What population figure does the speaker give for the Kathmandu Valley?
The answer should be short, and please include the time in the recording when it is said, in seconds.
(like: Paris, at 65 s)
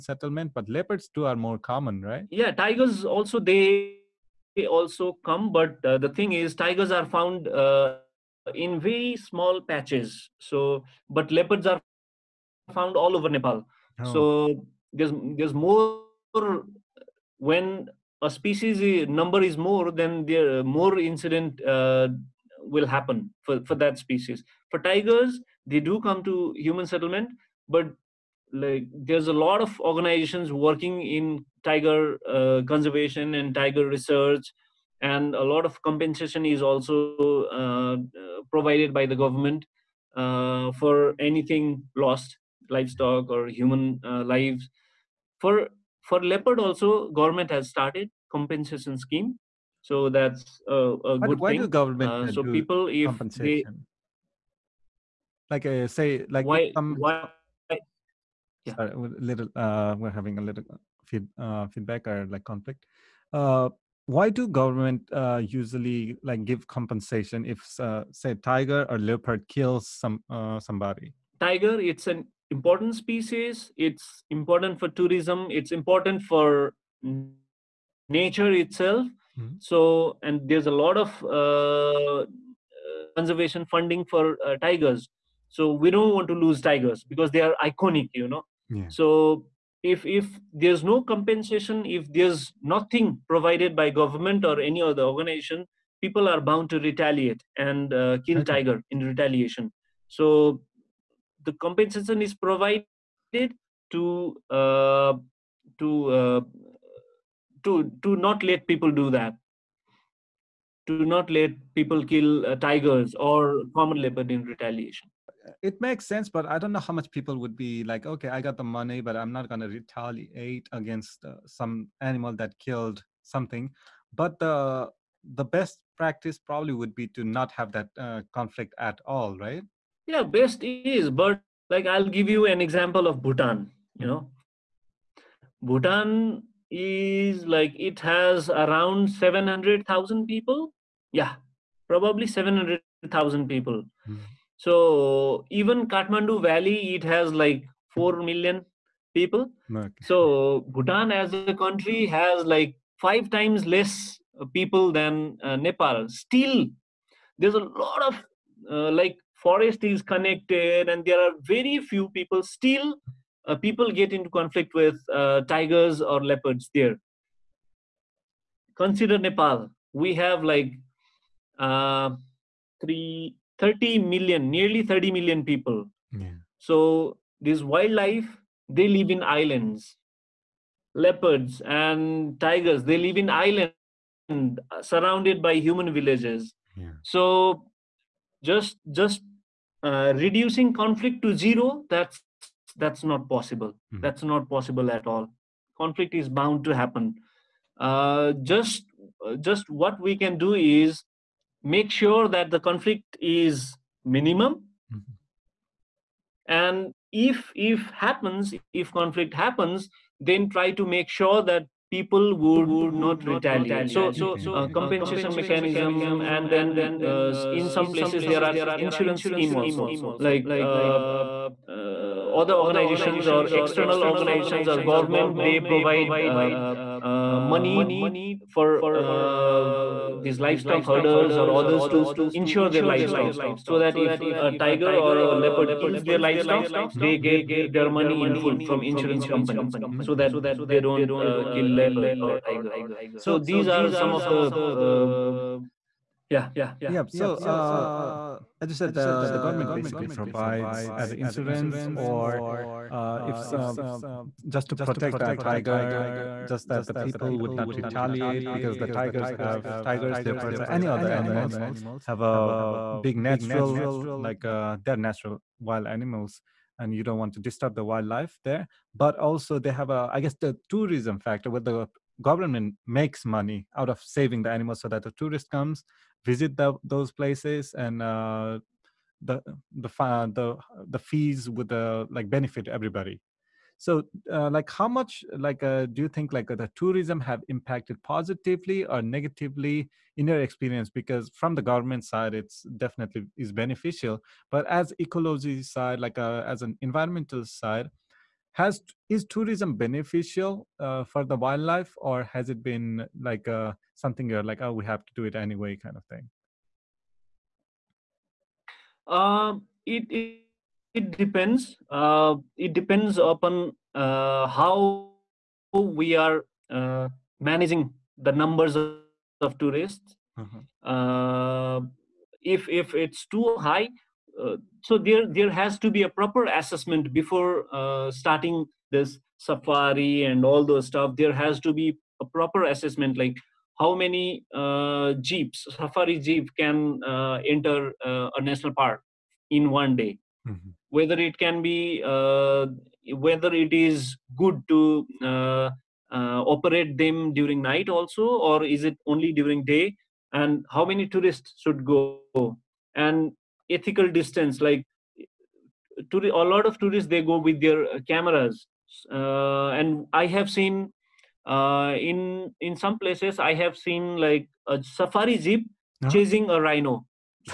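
4 million, at 147 s.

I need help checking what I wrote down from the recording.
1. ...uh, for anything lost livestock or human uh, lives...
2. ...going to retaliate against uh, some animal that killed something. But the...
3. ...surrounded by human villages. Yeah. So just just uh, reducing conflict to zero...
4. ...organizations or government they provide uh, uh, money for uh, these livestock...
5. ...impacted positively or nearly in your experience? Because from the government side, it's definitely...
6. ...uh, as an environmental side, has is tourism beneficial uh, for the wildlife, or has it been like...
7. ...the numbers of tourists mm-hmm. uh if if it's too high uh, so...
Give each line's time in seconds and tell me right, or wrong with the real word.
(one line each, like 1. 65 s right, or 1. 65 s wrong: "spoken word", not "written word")
1. 40 s right
2. 119 s right
3. 184 s right
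4. 224 s right
5. 287 s wrong: "negatively", not "nearly"
6. 296 s right
7. 318 s right.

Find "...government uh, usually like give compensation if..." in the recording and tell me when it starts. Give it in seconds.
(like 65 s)
64 s.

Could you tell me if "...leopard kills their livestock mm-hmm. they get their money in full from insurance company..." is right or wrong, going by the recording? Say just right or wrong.
right.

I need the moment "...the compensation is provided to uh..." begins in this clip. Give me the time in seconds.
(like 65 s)
101 s.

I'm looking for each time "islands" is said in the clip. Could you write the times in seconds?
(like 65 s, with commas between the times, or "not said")
179 s, 183 s.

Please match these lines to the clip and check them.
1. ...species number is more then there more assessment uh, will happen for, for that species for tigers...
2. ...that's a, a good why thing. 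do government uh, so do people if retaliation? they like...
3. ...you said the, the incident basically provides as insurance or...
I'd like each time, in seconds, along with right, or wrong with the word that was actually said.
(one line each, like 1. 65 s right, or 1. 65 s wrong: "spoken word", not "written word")
1. 18 s wrong: "incident", not "assessment"
2. 50 s wrong: "compensation", not "retaliation"
3. 248 s wrong: "government", not "incident".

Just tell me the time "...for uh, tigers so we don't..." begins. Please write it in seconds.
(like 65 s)
84 s.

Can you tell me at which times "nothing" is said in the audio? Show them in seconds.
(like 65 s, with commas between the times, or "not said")
92 s.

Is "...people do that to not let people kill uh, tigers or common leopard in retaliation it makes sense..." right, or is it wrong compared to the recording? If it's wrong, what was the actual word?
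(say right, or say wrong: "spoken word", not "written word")
right.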